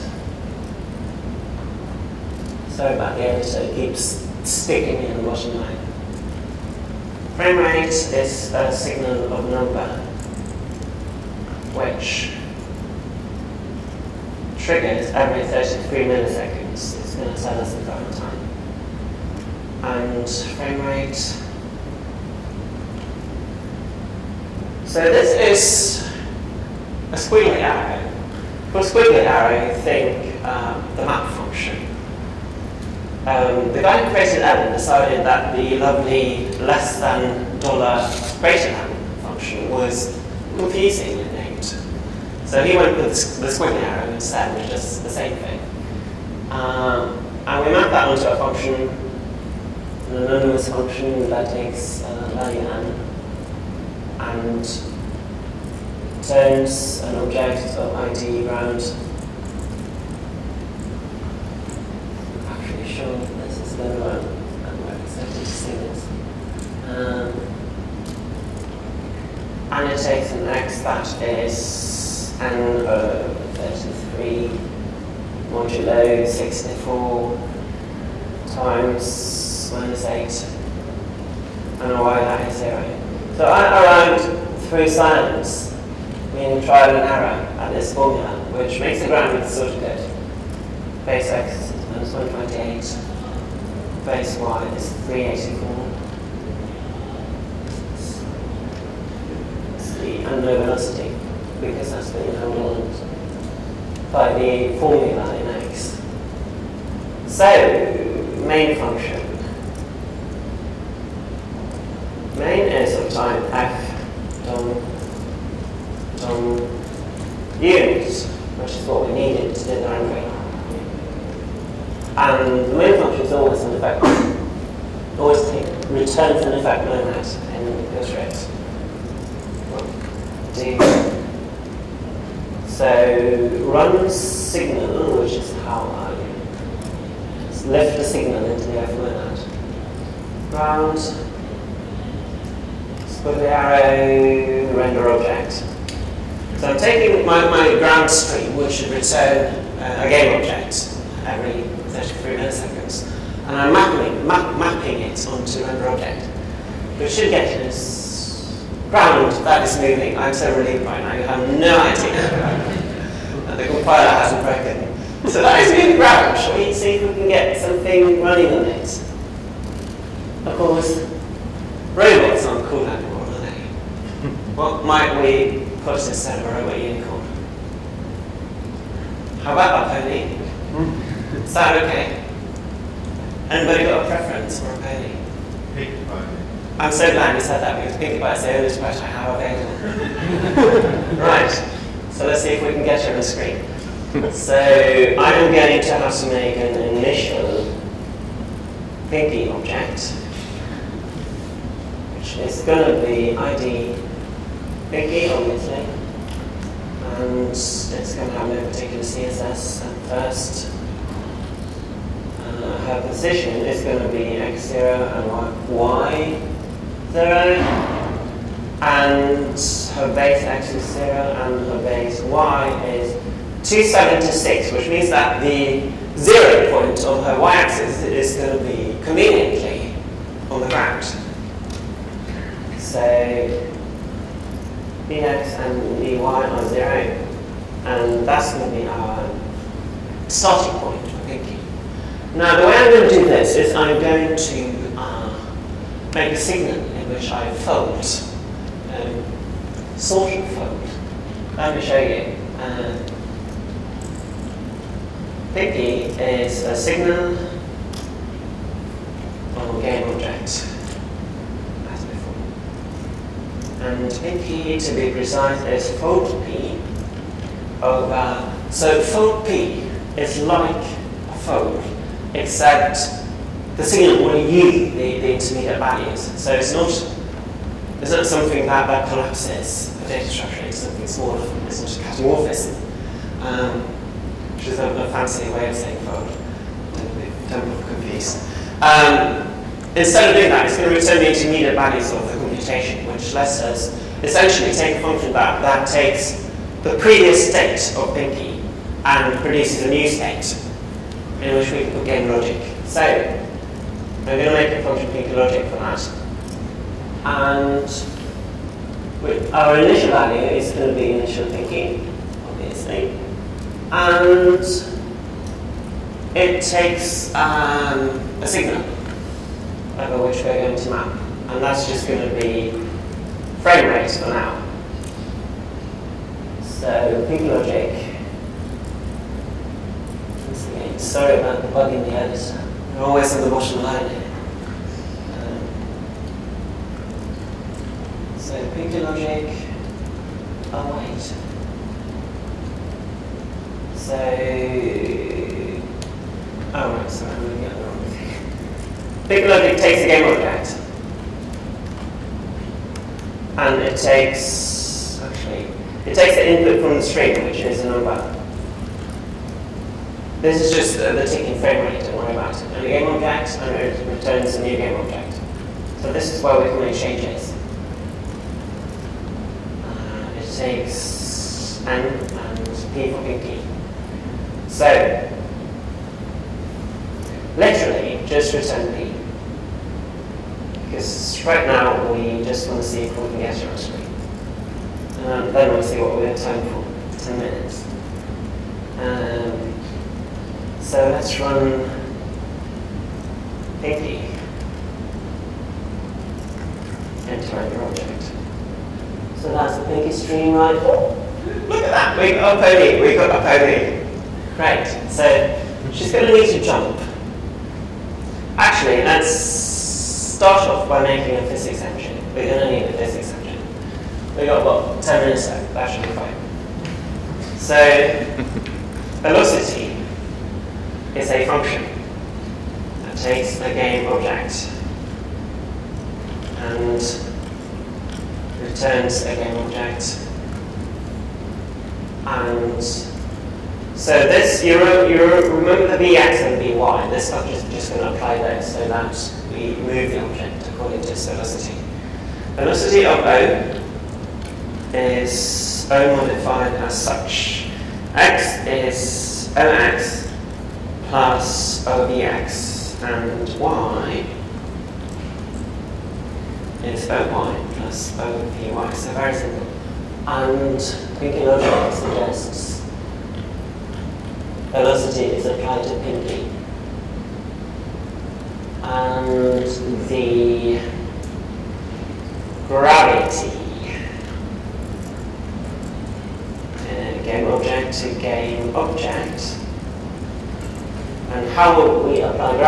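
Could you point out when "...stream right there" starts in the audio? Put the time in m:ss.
6:40.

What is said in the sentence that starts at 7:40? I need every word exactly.
And Pinky logic suggests velocity is applied to Pinky.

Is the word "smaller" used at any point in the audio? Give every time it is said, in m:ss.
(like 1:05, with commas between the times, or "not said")
4:41.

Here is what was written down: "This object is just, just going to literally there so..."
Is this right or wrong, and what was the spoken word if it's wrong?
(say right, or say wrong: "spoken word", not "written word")
wrong: "apply", not "literally".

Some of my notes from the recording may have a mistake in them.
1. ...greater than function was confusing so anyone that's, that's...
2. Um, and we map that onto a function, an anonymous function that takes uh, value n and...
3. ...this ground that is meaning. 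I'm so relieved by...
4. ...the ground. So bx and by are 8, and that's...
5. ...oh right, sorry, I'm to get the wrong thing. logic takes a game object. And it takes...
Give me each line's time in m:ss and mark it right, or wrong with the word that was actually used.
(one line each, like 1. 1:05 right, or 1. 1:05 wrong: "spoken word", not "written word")
1. 0:38 right
2. 0:46 right
3. 2:37 wrong: "moving", not "meaning"
4. 3:50 wrong: "0", not "8"
5. 5:46 right.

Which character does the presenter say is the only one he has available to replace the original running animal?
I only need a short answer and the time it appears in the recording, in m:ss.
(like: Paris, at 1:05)
Pinkie Pie, at 3:07.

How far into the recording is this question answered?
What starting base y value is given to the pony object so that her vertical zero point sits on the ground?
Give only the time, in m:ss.
3:43.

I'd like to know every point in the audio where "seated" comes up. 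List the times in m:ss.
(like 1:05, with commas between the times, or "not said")
not said.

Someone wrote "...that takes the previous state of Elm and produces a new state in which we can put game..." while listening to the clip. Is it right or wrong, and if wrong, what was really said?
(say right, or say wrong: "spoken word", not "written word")
wrong: "Pinky", not "Elm".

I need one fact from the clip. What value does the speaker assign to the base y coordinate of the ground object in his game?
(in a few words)
384.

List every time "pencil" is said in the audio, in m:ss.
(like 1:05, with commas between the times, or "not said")
not said.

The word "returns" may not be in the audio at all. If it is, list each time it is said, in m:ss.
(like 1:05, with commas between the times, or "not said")
2:05, 2:28, 4:50, 6:04, 6:18, 7:08.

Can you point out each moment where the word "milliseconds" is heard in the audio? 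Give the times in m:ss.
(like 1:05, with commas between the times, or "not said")
0:16, 2:32.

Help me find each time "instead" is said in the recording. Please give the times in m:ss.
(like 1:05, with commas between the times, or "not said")
2:55, 4:49.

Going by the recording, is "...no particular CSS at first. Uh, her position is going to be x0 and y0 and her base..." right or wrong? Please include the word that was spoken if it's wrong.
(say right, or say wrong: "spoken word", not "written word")
right.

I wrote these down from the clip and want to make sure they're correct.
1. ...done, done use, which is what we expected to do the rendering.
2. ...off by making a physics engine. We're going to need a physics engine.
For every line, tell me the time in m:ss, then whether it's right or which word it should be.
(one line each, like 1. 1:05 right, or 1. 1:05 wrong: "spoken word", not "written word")
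1. 1:54 wrong: "needed", not "expected"
2. 6:50 right.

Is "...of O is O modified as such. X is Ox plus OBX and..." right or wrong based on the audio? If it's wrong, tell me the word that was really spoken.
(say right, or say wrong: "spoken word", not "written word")
right.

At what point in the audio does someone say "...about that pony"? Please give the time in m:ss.
2:59.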